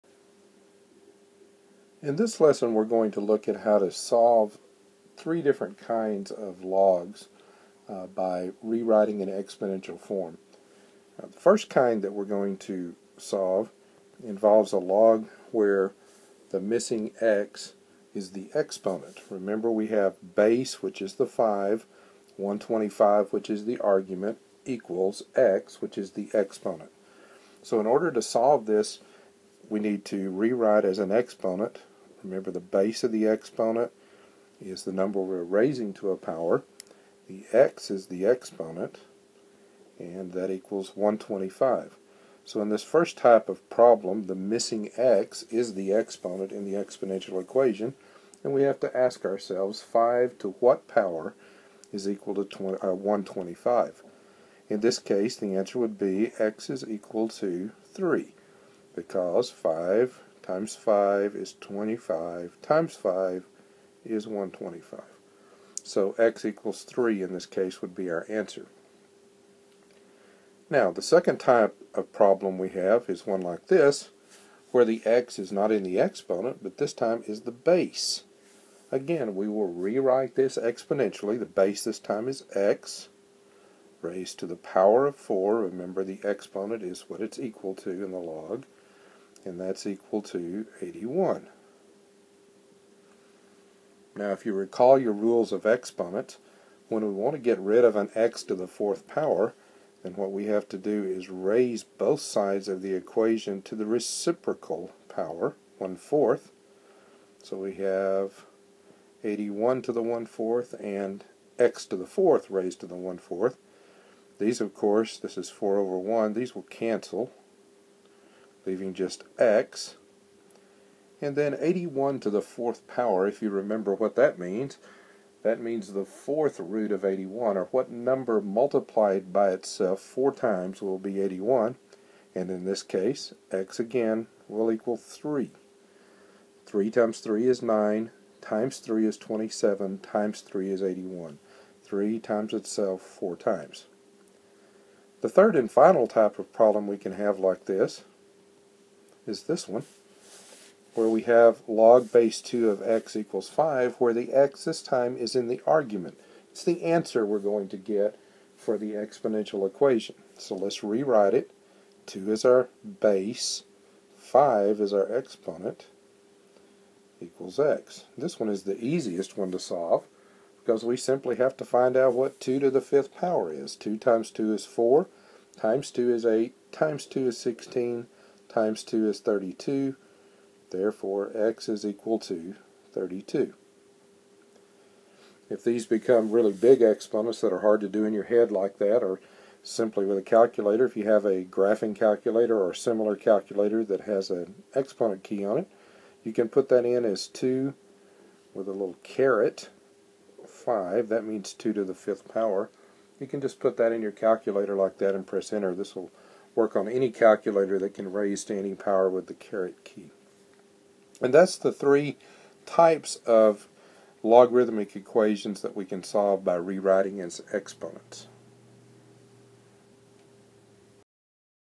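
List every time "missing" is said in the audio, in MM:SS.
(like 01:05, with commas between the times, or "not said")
00:16, 00:44.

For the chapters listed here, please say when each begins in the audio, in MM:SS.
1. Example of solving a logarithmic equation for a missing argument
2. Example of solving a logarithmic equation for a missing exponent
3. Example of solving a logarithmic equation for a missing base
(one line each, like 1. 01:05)
1. 02:28
2. 00:14
3. 01:10.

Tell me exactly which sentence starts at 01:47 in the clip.
So we have 81 to the 1 fourth and x to the fourth raised to the 1 fourth.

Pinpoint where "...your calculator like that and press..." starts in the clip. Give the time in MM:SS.
03:24.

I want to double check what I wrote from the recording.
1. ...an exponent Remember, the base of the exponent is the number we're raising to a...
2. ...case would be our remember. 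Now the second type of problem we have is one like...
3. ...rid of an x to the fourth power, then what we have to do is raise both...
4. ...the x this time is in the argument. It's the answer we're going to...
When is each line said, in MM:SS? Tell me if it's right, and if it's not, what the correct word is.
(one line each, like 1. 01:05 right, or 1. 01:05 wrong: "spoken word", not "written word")
1. 00:30 right
2. 01:07 wrong: "answer", not "remember"
3. 01:37 right
4. 02:34 right.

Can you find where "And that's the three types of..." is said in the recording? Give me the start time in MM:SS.
03:31.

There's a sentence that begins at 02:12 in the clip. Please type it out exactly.
And in this case, x again will equal 3.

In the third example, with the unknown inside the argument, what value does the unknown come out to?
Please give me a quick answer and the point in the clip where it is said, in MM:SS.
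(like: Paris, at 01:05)
32, at 03:01.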